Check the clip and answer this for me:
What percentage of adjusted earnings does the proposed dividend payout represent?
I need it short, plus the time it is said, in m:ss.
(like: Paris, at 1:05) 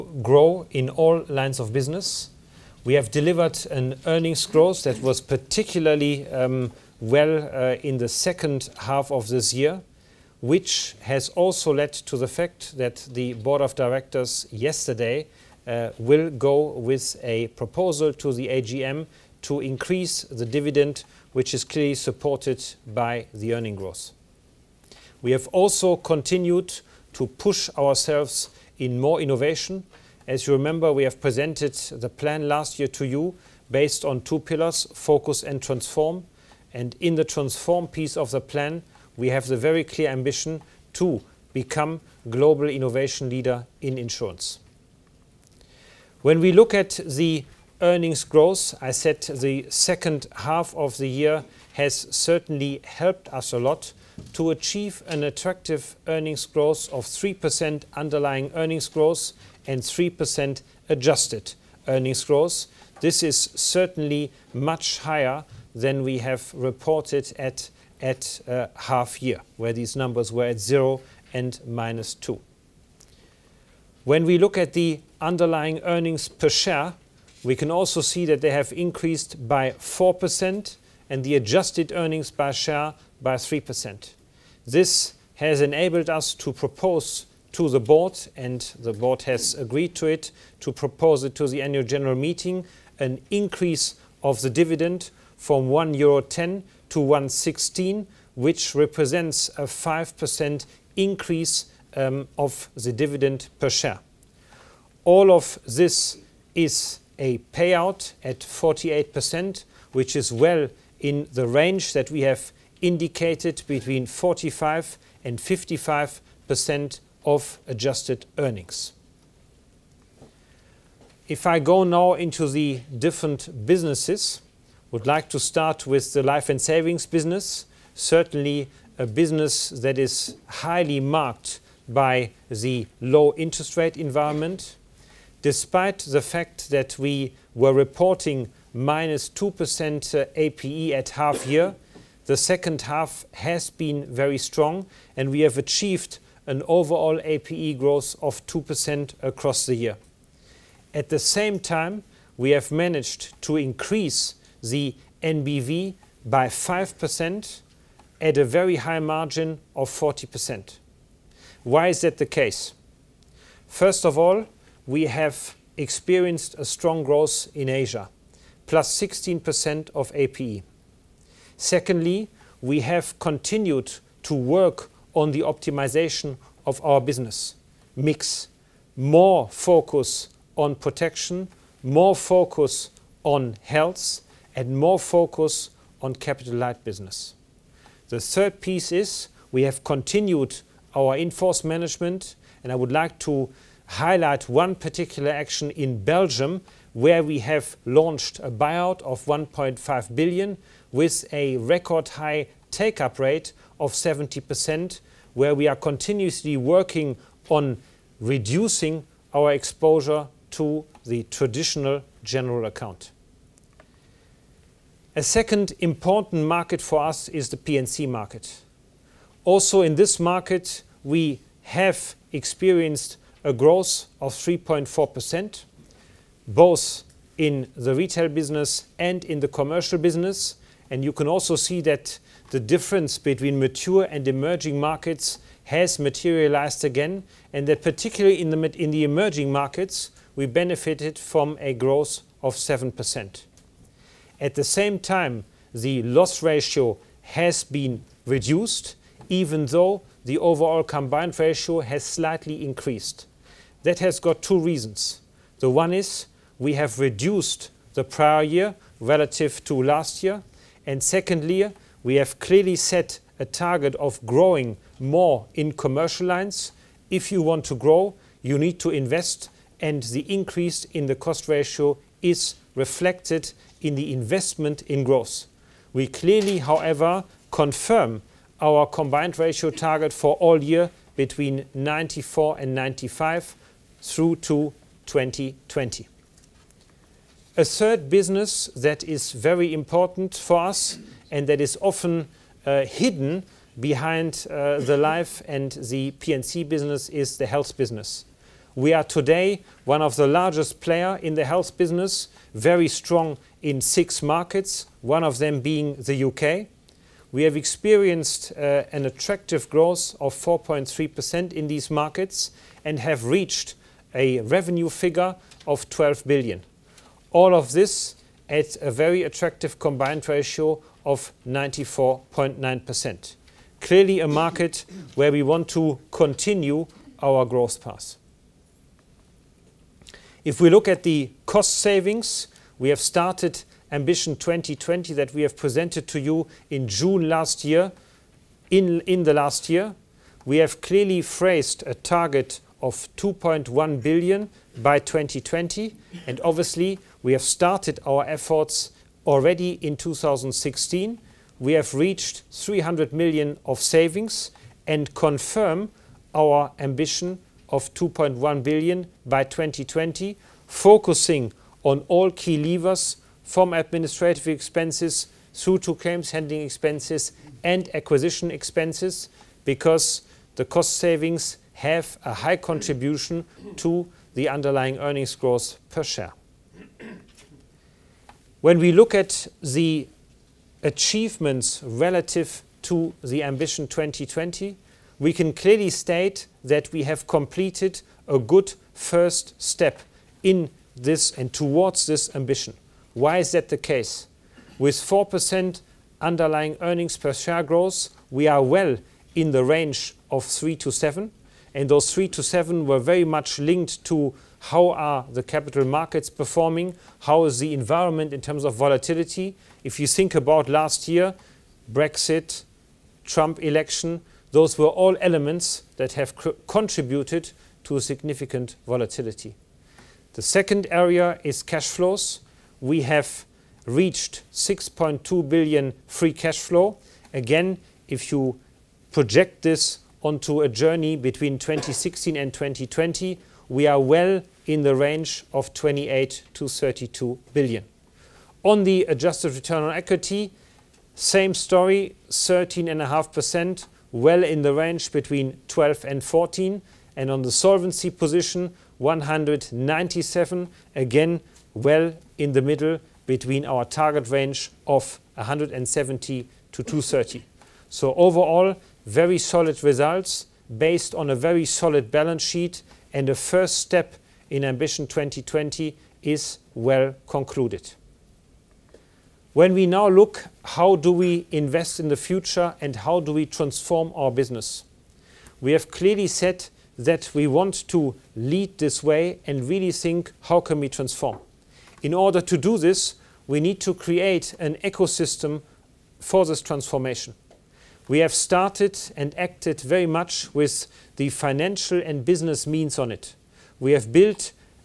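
48%, at 1:48.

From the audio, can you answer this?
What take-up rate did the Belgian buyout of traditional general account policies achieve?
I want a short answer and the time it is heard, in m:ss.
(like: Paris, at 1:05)
70%, at 3:23.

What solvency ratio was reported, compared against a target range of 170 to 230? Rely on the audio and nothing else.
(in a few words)
197.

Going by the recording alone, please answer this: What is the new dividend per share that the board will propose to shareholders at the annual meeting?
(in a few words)
1.16 euro.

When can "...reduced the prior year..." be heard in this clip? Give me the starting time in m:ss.
4:16.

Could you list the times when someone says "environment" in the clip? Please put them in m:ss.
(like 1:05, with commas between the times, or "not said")
2:13, 6:47.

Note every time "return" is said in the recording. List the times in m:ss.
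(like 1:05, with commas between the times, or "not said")
7:19.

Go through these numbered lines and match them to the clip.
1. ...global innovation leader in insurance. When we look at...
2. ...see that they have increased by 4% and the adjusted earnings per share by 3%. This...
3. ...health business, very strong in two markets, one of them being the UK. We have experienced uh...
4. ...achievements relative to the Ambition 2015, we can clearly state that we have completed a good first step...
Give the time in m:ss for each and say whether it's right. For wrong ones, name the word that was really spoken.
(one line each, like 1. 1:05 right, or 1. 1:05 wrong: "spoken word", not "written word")
1. 0:42 right
2. 1:18 right
3. 5:01 wrong: "six", not "two"
4. 6:20 wrong: "2020", not "2015".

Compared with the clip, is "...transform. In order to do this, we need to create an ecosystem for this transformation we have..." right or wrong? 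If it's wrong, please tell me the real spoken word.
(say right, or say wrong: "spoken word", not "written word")
right.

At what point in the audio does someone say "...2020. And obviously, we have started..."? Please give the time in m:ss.
5:44.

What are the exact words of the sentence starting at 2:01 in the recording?
If I go now into the different businesses, would like to start with the life and savings business.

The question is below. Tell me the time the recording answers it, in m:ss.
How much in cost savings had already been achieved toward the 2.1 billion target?
5:52.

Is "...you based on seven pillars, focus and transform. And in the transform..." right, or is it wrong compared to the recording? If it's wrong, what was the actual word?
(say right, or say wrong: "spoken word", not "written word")
wrong: "two", not "seven".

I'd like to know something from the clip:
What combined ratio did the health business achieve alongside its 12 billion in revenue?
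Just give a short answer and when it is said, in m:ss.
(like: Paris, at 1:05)
94.9%, at 5:21.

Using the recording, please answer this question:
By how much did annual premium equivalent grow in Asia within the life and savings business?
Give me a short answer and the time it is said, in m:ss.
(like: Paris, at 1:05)
16%, at 2:48.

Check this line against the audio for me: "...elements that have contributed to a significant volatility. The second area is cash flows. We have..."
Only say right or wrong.
right.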